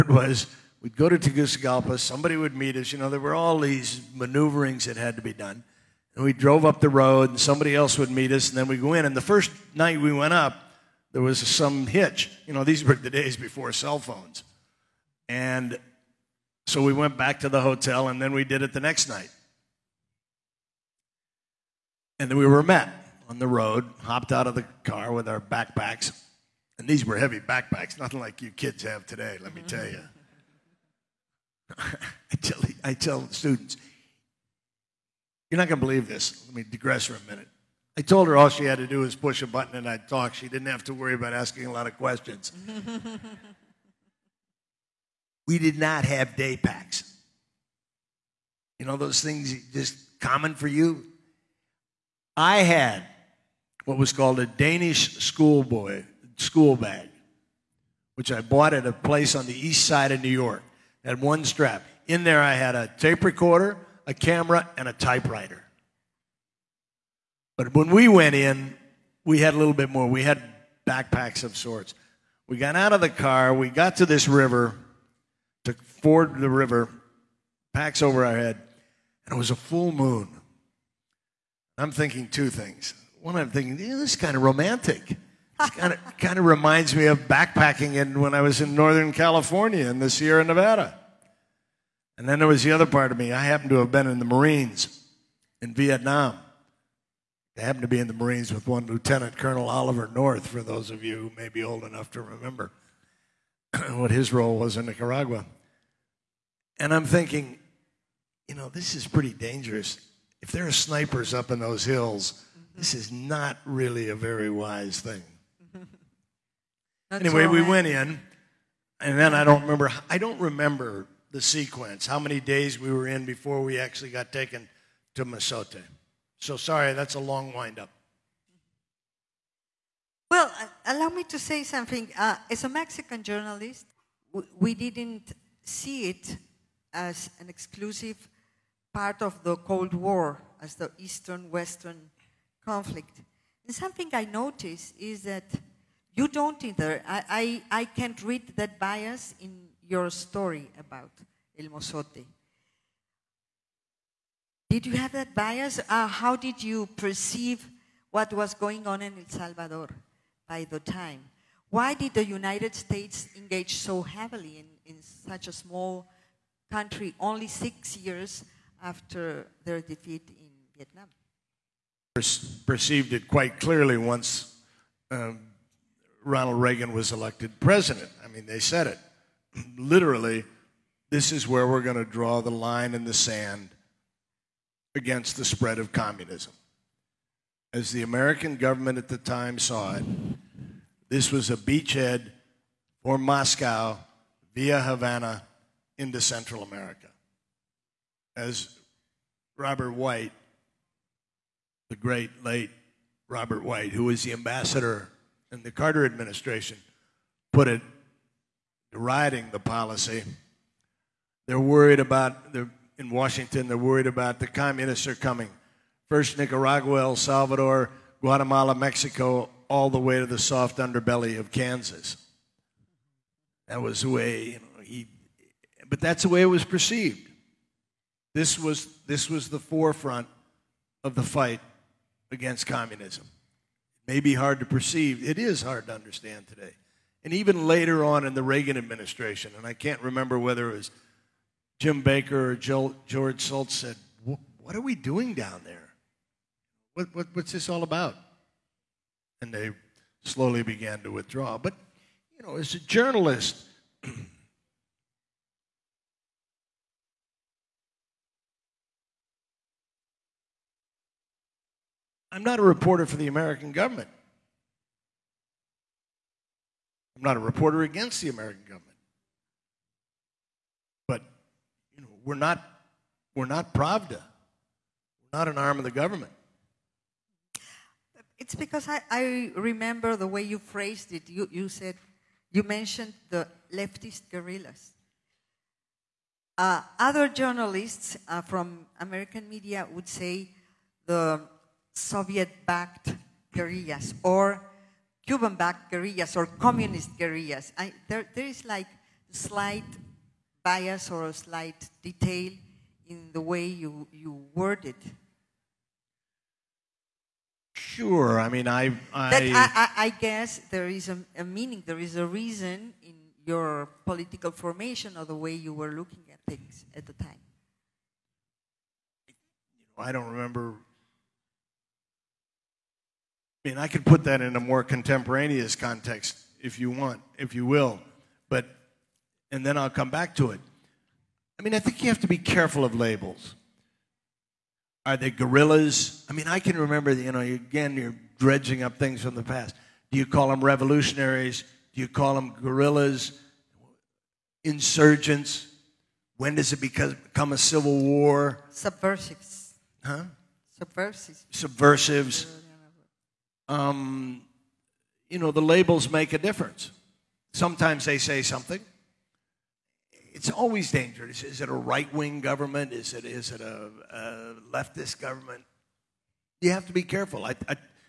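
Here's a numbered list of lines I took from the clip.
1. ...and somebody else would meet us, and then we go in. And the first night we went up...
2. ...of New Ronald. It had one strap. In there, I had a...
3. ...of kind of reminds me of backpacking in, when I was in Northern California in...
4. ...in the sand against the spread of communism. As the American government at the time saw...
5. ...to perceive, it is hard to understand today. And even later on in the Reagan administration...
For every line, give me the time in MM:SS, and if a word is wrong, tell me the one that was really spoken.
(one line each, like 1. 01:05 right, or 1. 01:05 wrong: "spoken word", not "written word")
1. 00:07 right
2. 01:00 wrong: "York", not "Ronald"
3. 01:25 right
4. 03:02 right
5. 03:54 right.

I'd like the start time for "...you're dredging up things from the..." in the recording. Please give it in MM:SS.
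05:37.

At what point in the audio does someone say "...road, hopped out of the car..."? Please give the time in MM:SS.
00:23.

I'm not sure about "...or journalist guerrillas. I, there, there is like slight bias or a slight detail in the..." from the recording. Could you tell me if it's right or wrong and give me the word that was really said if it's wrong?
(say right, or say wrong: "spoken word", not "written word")
wrong: "communist", not "journalist".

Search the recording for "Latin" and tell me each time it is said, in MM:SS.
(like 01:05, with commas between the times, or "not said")
not said.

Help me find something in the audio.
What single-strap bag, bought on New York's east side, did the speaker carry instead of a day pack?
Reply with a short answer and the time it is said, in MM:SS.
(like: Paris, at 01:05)
Danish schoolboy school bag, at 00:54.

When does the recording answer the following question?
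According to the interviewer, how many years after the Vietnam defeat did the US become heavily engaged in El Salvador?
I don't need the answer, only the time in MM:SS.
02:47.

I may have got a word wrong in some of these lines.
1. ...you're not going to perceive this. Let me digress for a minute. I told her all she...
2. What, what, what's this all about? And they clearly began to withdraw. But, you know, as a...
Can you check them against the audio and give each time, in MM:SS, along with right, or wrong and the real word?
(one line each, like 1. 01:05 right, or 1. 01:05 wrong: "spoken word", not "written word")
1. 00:35 wrong: "believe", not "perceive"
2. 04:06 wrong: "slowly", not "clearly".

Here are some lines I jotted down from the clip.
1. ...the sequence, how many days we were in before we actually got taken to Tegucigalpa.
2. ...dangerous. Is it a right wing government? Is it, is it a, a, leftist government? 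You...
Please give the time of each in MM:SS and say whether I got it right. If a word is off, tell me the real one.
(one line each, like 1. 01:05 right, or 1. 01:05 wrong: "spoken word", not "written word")
1. 02:01 wrong: "Mozote", not "Tegucigalpa"
2. 06:00 right.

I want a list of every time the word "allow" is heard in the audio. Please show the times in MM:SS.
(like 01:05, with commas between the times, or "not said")
02:10.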